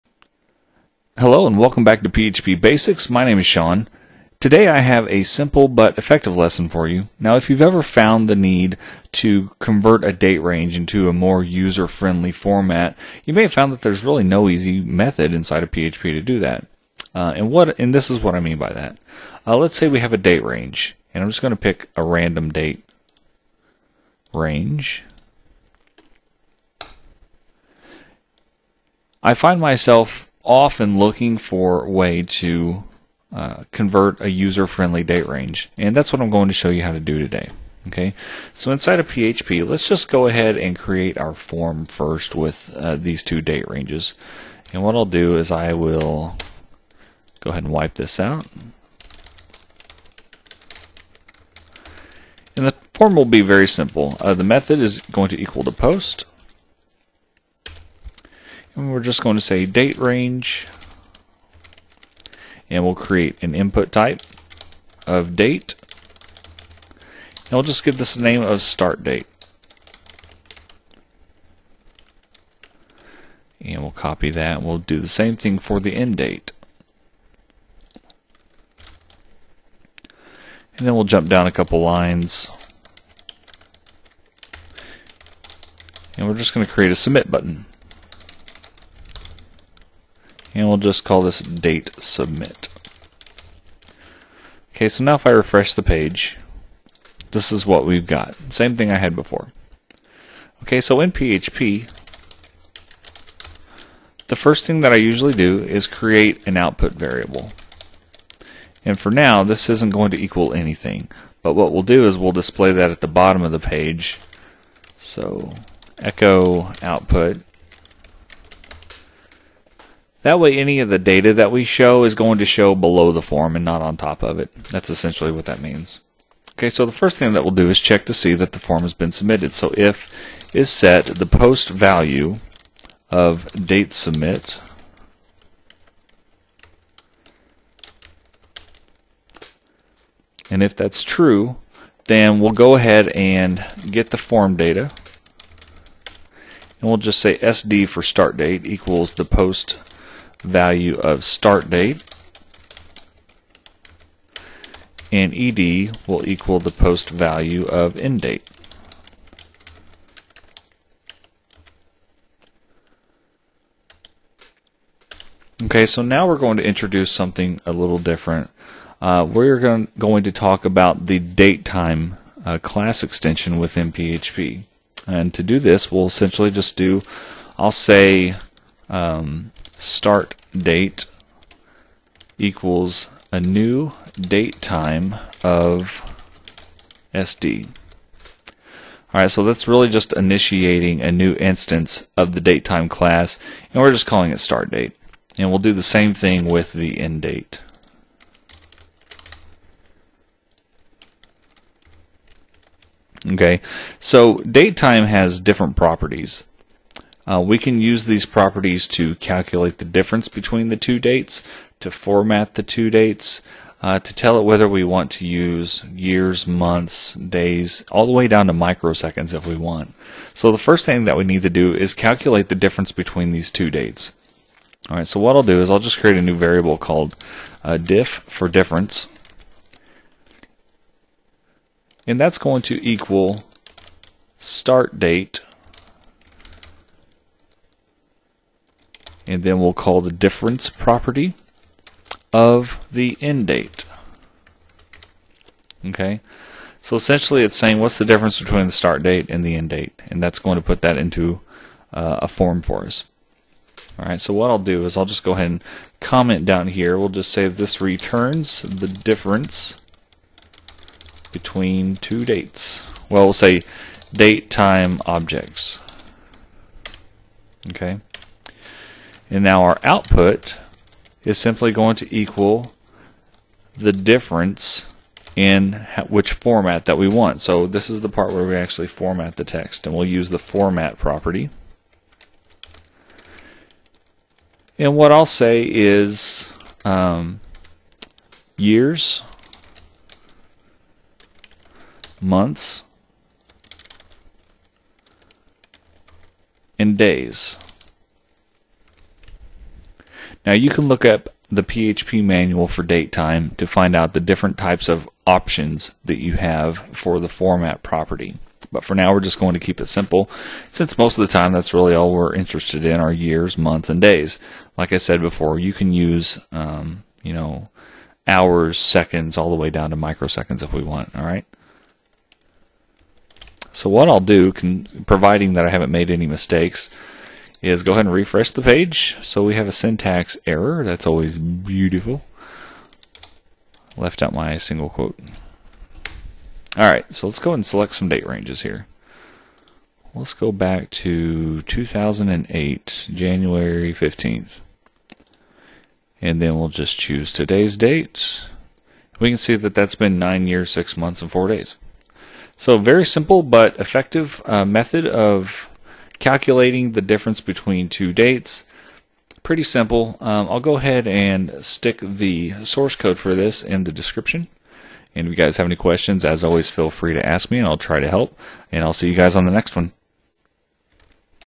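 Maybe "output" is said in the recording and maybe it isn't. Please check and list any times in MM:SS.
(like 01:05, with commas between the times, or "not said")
01:46, 01:56, 04:29.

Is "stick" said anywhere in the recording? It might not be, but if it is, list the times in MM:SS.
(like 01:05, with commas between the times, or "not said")
06:01.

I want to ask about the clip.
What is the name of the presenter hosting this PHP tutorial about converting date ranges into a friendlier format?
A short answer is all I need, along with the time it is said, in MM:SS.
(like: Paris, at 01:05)
Sean, at 00:03.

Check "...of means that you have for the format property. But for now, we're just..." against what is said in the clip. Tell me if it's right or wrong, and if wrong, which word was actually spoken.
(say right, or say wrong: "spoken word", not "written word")
wrong: "options", not "means".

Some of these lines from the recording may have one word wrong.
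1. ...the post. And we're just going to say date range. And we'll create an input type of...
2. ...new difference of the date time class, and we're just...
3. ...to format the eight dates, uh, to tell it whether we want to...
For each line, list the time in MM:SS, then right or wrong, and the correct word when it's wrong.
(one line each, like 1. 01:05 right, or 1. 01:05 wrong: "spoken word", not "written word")
1. 00:55 right
2. 03:11 wrong: "instance", not "difference"
3. 03:31 wrong: "two", not "eight".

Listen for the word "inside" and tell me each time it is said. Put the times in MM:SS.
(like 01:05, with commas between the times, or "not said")
00:15, 00:38.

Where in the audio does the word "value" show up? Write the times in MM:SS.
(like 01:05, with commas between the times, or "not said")
02:11, 02:30, 02:37.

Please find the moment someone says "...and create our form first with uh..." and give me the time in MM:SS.
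00:40.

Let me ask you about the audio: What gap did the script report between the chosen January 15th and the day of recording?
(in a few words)
9 years, 6 months, and 4 days.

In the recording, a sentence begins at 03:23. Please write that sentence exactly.
Okay, so date time has different properties.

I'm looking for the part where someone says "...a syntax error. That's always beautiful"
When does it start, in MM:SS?
05:29.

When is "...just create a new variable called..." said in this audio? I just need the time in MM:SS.
03:45.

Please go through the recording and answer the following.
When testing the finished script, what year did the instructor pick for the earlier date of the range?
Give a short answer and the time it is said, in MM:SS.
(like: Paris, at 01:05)
2008, at 05:41.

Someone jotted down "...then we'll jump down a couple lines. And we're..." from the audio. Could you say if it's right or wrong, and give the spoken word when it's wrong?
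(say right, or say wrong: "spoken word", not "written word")
right.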